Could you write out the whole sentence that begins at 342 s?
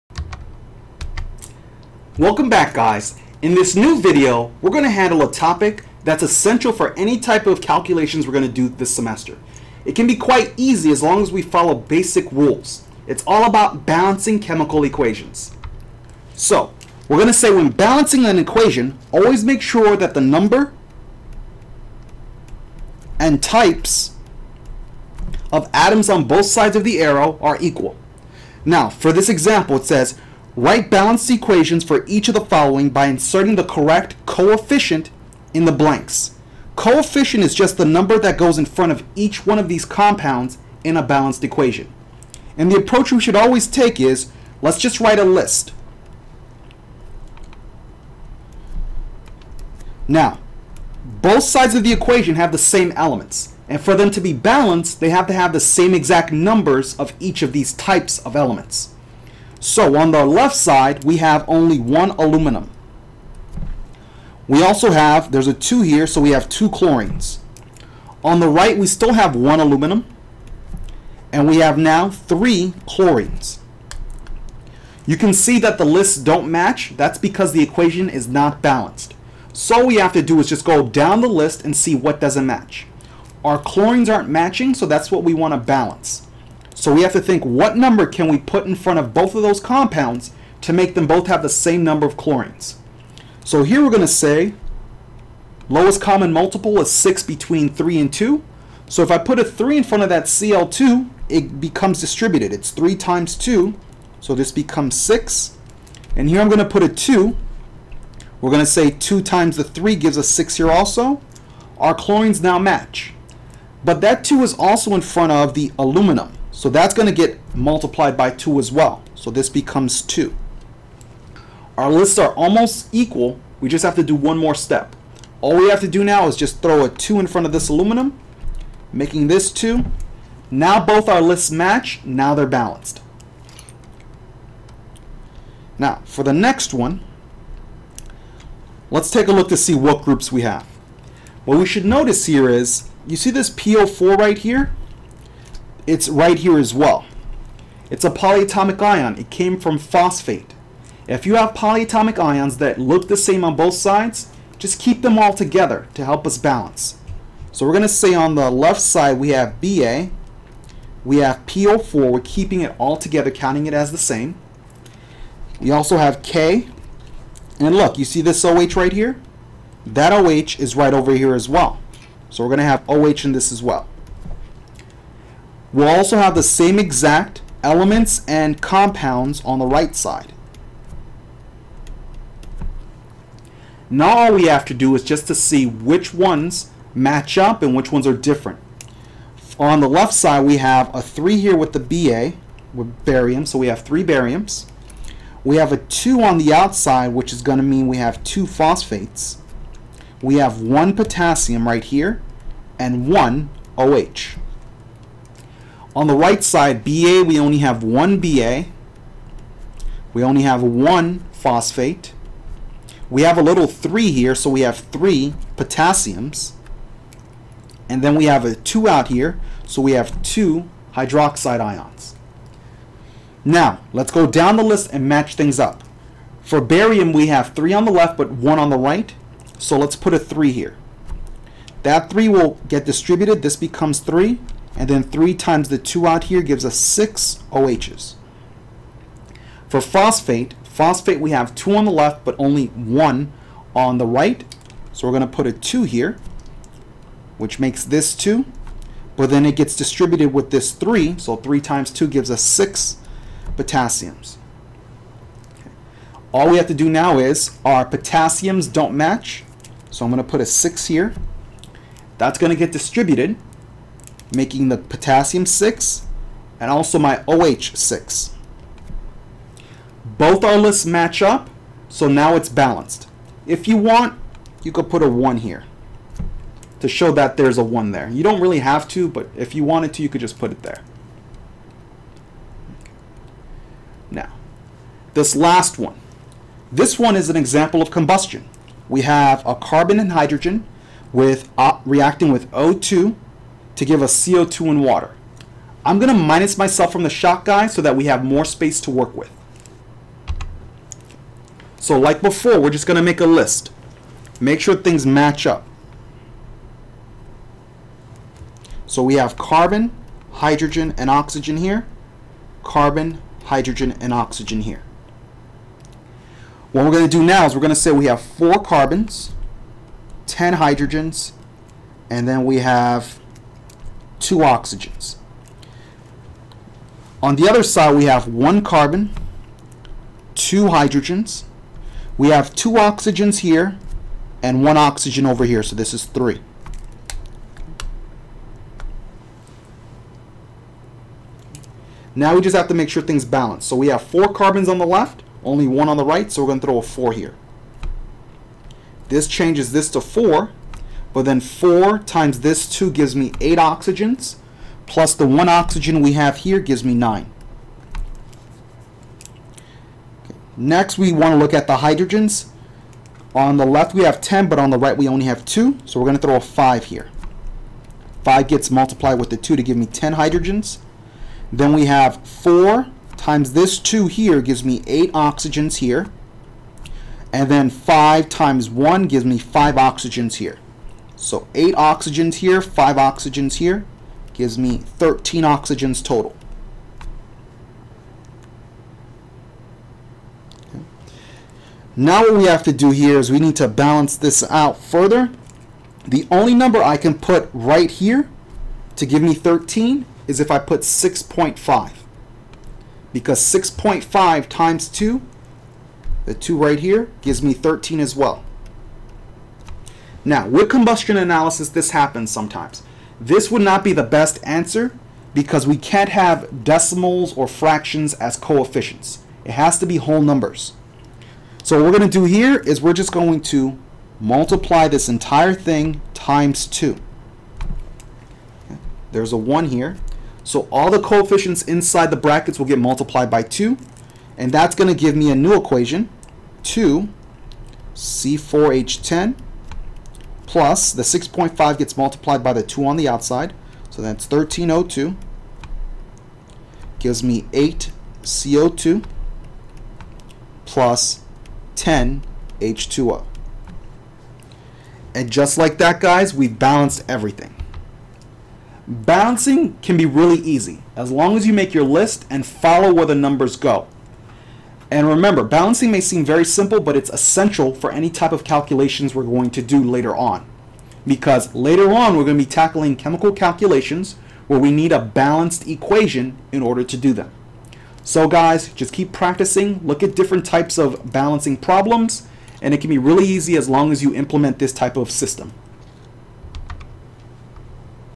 Now we just have to make sure things balance.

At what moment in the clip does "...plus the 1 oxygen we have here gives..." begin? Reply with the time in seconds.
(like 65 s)
354 s.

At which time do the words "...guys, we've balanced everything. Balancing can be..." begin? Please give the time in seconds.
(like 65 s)
456 s.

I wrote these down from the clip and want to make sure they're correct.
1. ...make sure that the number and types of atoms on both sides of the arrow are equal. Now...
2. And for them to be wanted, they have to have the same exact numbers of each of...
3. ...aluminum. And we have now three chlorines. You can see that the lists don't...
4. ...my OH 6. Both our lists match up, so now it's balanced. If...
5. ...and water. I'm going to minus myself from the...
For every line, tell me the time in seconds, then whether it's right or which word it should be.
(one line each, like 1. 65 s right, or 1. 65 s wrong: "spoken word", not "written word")
1. 19 s right
2. 53 s wrong: "balanced", not "wanted"
3. 69 s right
4. 266 s right
5. 294 s right.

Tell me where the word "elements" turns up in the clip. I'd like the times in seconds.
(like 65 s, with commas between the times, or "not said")
52 s, 58 s, 177 s.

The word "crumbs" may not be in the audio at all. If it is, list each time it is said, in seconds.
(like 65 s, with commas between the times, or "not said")
not said.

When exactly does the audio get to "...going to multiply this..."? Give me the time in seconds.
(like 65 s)
423 s.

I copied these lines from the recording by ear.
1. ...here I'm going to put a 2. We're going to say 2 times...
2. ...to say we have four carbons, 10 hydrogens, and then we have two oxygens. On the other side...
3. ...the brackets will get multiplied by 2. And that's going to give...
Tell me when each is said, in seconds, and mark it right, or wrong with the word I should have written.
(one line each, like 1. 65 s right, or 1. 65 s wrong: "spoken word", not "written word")
1. 106 s right
2. 317 s right
3. 432 s right.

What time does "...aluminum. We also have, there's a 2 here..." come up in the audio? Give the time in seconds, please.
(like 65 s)
62 s.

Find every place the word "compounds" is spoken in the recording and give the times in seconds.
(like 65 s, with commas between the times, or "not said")
39 s, 89 s, 178 s.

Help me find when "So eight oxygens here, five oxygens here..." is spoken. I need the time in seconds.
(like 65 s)
381 s.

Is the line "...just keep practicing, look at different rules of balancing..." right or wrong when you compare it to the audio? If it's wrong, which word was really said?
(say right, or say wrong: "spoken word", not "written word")
wrong: "types", not "rules".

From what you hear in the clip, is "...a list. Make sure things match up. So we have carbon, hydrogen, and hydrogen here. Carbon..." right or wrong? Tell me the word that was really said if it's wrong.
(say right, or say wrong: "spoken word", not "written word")
wrong: "oxygen", not "hydrogen".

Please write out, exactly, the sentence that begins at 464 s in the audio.
And remember, balancing may seem very simple, but it's essential for any type of calculations we're going to do later on.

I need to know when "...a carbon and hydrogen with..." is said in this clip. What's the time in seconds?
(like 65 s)
289 s.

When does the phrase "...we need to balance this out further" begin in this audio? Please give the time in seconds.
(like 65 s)
393 s.